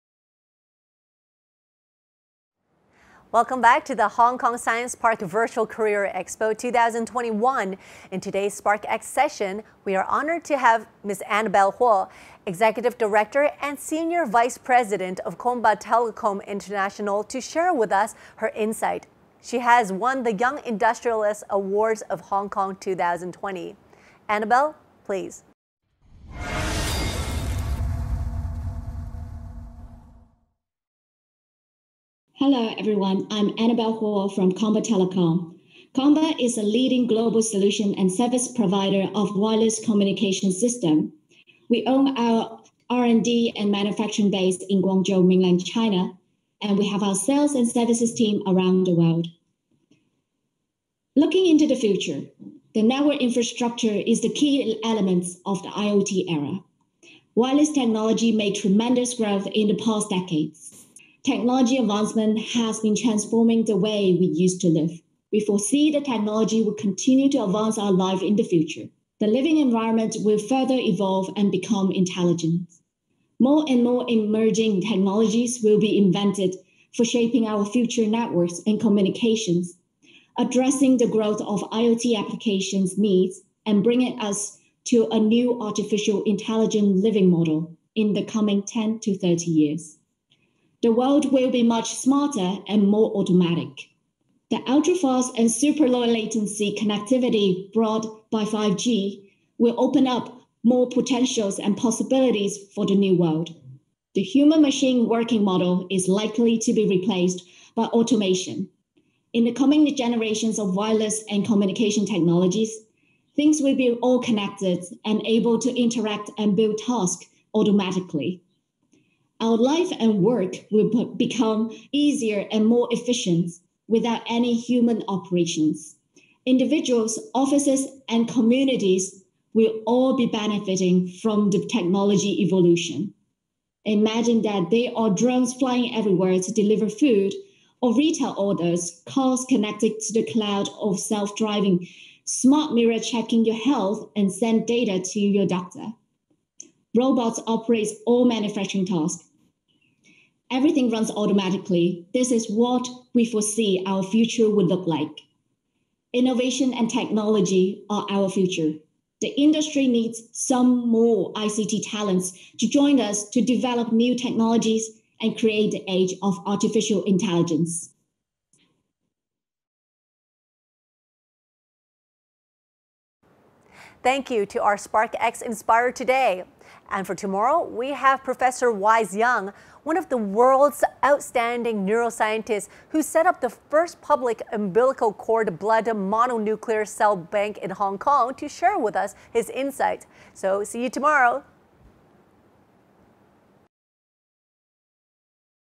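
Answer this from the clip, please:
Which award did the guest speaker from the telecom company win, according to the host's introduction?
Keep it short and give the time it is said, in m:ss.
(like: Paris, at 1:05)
Young Industrialist Awards of Hong Kong 2020, at 0:20.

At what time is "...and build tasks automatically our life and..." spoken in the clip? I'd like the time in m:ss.
1:56.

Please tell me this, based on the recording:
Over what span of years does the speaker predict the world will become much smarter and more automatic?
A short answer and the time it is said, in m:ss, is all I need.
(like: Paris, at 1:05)
10 to 30 years, at 1:28.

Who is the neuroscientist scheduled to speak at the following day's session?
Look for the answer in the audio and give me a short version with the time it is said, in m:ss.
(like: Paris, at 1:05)
Wise Young, at 2:58.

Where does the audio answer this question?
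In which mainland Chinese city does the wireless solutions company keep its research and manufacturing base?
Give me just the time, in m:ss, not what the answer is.
0:44.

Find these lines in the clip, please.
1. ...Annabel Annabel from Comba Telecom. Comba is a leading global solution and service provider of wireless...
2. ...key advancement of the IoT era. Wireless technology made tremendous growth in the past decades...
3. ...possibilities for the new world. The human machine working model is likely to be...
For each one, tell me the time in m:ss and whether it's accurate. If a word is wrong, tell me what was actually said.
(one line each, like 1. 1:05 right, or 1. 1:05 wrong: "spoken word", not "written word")
1. 0:33 wrong: "Huo", not "Annabel"
2. 0:54 wrong: "element", not "advancement"
3. 1:41 right.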